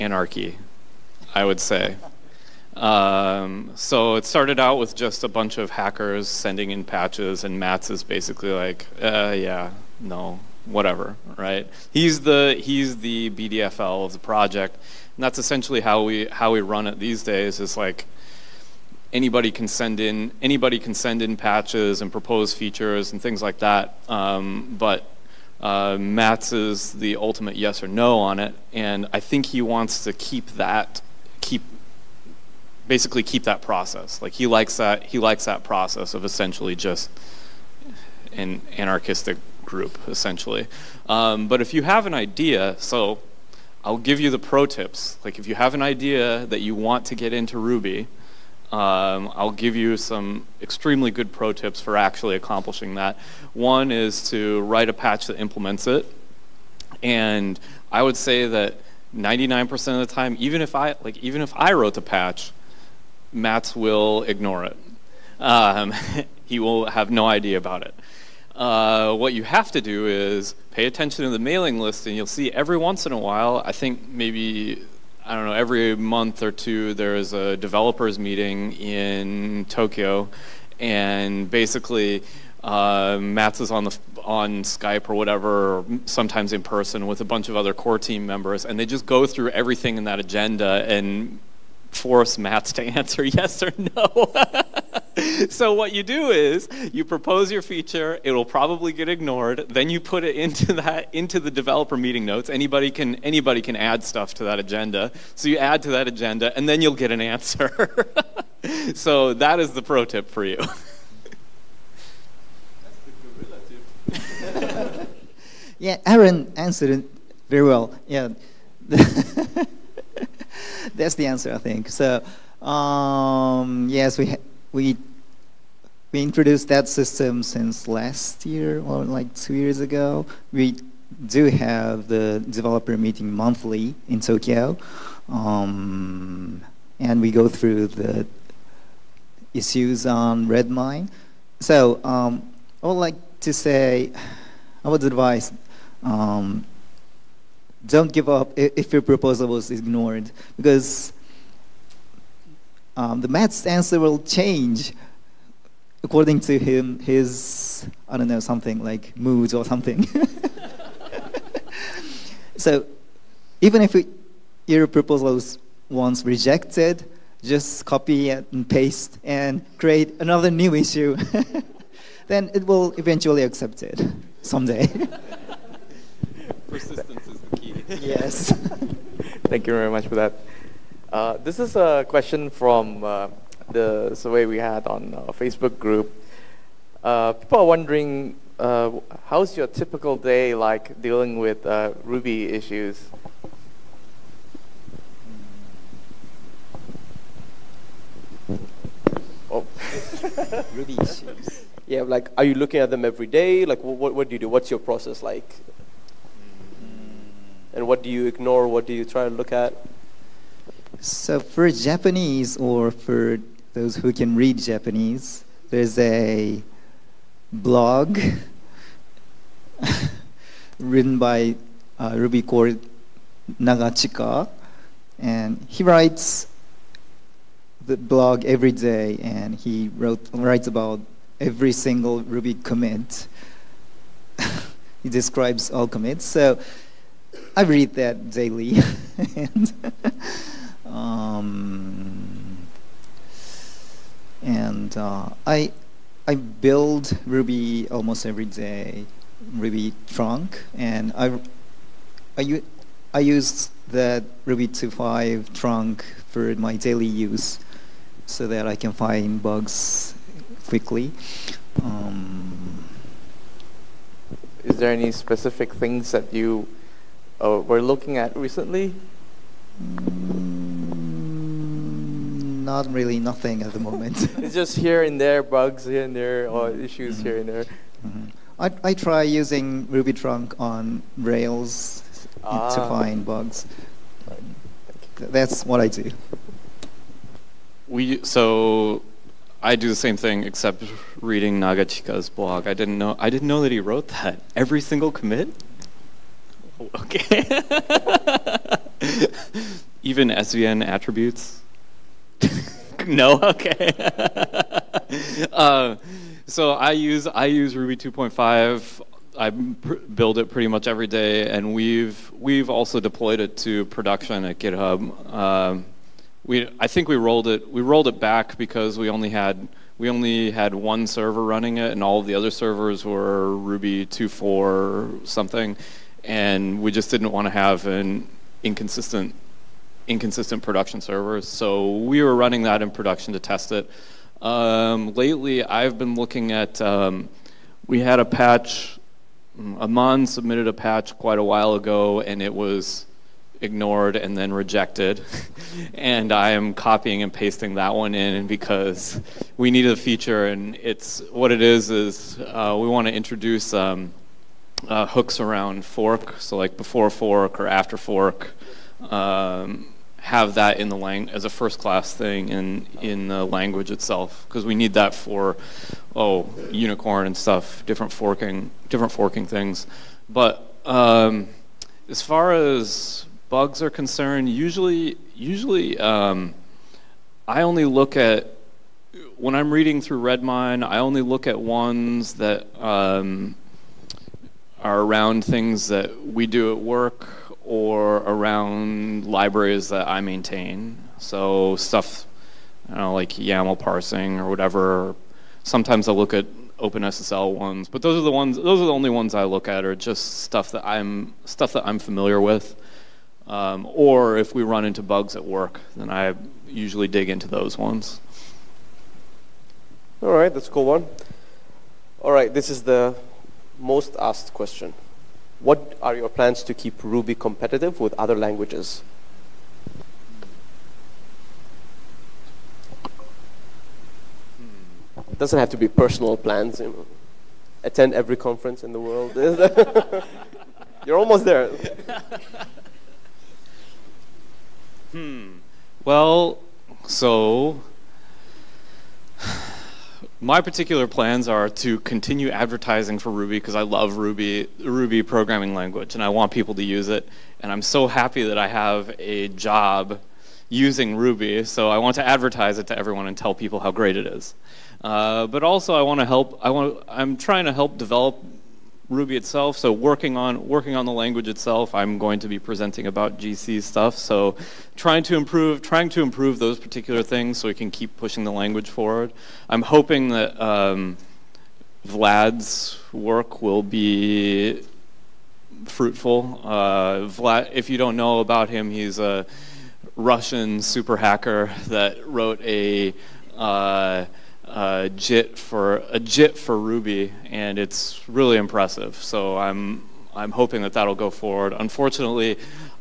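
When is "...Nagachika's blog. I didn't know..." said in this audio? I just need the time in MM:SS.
04:51.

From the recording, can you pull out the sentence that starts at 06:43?
Um, or if we run into bugs at work, then I usually dig into those ones.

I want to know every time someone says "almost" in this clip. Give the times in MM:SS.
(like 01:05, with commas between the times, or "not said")
04:07, 07:11.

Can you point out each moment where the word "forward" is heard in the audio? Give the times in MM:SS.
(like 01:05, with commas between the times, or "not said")
07:48, 08:11.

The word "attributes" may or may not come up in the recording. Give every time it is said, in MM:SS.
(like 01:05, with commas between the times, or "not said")
05:00.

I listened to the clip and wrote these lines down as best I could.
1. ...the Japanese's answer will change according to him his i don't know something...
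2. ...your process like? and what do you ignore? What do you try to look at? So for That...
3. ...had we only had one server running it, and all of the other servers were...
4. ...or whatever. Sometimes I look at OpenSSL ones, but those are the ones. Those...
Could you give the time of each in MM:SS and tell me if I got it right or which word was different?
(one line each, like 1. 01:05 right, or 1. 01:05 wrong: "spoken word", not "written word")
1. 02:33 wrong: "Matz", not "Japanese"
2. 03:24 wrong: "Japanese", not "That"
3. 05:19 right
4. 06:34 right.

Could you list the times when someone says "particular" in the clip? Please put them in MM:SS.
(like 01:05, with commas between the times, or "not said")
07:20, 07:46.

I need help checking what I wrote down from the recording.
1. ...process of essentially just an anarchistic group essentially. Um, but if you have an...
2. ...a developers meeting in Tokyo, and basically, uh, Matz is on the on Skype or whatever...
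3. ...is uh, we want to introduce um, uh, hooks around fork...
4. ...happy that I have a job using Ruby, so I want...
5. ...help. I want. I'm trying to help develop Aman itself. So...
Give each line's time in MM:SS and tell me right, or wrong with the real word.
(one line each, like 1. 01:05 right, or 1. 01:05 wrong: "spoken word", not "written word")
1. 00:35 right
2. 01:17 right
3. 05:51 right
4. 07:28 right
5. 07:36 wrong: "Ruby", not "Aman".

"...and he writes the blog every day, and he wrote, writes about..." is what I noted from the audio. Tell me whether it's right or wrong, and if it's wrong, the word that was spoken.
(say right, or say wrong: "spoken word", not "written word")
right.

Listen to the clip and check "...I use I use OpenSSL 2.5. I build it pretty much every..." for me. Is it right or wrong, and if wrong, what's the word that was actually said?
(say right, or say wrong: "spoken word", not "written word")
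wrong: "Ruby", not "OpenSSL".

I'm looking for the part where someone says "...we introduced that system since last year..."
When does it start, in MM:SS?
02:06.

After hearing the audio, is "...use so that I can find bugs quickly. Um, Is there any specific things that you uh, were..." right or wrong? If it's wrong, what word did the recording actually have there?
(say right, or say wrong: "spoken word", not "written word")
right.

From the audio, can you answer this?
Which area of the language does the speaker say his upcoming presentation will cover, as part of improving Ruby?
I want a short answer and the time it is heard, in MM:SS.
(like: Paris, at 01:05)
GC, at 07:43.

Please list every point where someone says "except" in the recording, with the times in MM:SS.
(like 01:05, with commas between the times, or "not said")
04:50.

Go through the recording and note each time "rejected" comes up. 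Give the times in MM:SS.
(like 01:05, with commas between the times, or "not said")
02:46, 05:44.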